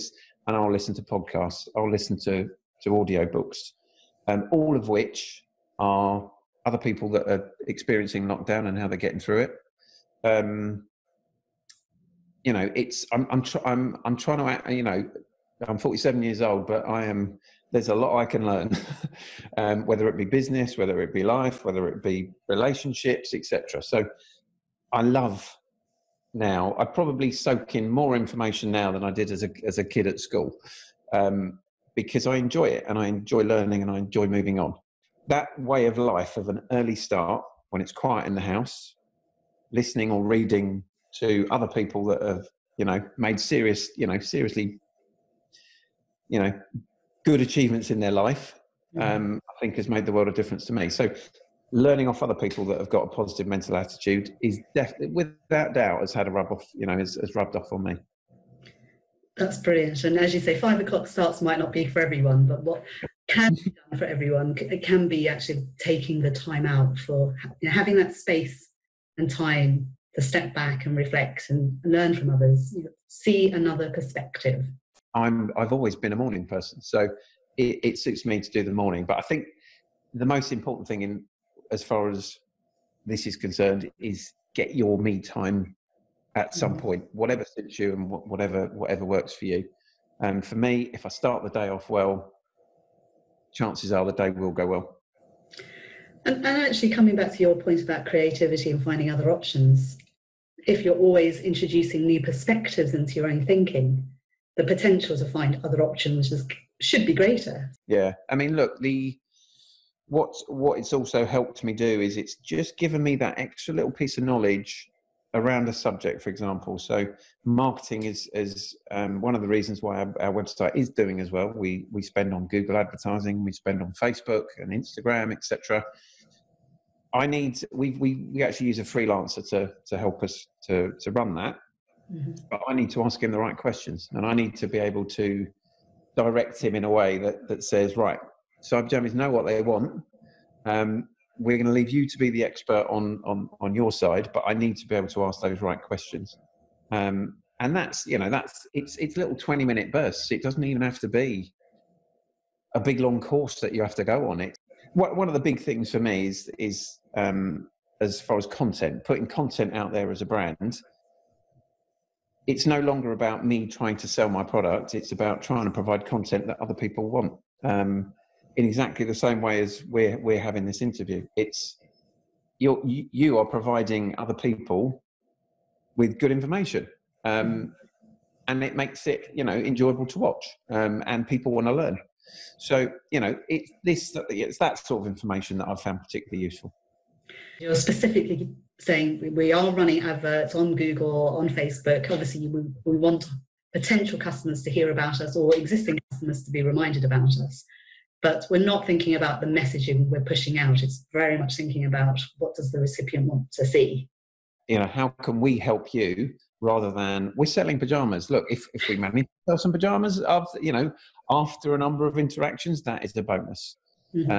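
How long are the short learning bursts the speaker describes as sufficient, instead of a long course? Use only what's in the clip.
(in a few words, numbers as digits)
20 minutes.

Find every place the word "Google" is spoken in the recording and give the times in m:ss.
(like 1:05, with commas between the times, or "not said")
2:02, 3:10.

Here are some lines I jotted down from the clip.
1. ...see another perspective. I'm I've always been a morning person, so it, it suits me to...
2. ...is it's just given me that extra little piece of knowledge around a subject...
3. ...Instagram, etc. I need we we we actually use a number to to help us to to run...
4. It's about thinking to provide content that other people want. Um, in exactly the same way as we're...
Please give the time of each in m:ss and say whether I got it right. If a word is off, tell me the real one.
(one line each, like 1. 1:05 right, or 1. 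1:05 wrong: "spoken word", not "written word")
1. 1:13 right
2. 1:52 right
3. 2:04 wrong: "freelancer", not "number"
4. 2:44 wrong: "trying", not "thinking".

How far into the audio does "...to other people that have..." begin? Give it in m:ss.
0:41.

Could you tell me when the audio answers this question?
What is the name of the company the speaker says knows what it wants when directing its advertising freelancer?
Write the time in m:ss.
2:18.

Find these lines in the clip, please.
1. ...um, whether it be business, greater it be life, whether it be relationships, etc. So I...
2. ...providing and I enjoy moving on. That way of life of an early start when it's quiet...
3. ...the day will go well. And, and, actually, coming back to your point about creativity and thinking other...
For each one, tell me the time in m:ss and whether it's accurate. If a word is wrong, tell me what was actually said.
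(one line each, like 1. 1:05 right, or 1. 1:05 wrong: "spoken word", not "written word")
1. 0:19 wrong: "whether", not "greater"
2. 0:33 wrong: "learning", not "providing"
3. 1:34 wrong: "finding", not "thinking".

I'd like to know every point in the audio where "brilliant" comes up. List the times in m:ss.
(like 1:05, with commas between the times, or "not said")
0:59.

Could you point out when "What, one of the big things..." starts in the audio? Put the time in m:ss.
2:34.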